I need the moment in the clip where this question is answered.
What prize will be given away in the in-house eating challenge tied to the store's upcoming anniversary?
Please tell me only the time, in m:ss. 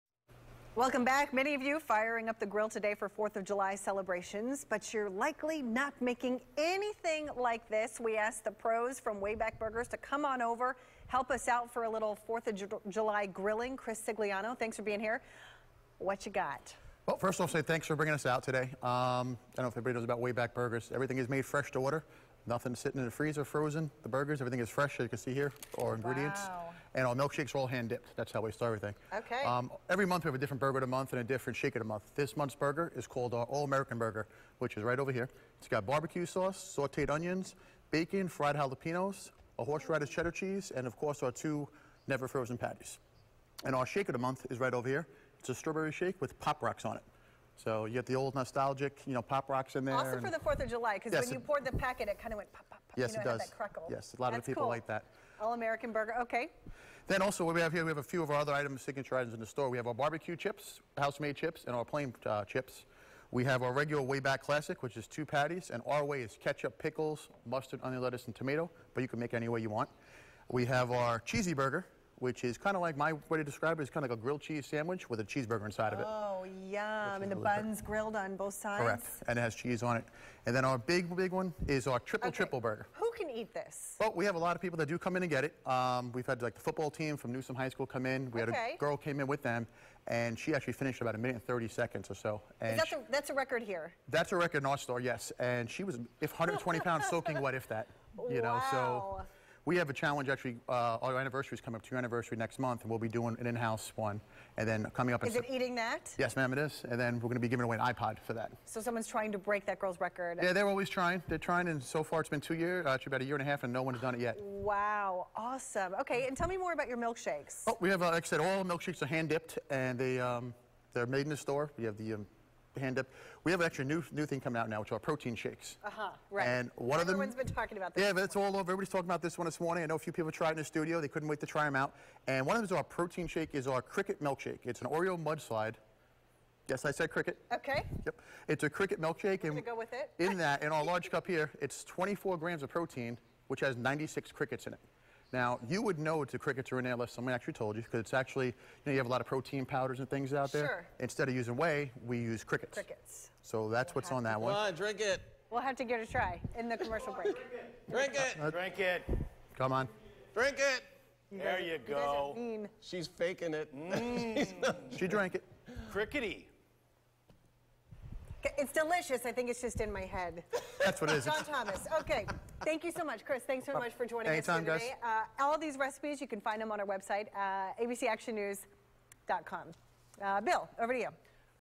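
1:47.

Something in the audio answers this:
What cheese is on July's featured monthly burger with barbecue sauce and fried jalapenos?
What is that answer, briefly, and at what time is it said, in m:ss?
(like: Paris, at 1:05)
Horseradish cheddar, at 0:39.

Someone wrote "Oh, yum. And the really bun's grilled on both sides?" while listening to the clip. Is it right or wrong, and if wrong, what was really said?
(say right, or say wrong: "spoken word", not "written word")
right.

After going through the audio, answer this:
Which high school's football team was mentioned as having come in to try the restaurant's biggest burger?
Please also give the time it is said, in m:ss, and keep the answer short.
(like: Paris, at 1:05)
Newsome High School, at 1:27.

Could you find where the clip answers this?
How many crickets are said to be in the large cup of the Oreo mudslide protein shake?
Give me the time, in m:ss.
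2:23.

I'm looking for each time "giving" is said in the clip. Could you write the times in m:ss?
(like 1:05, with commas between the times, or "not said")
1:47.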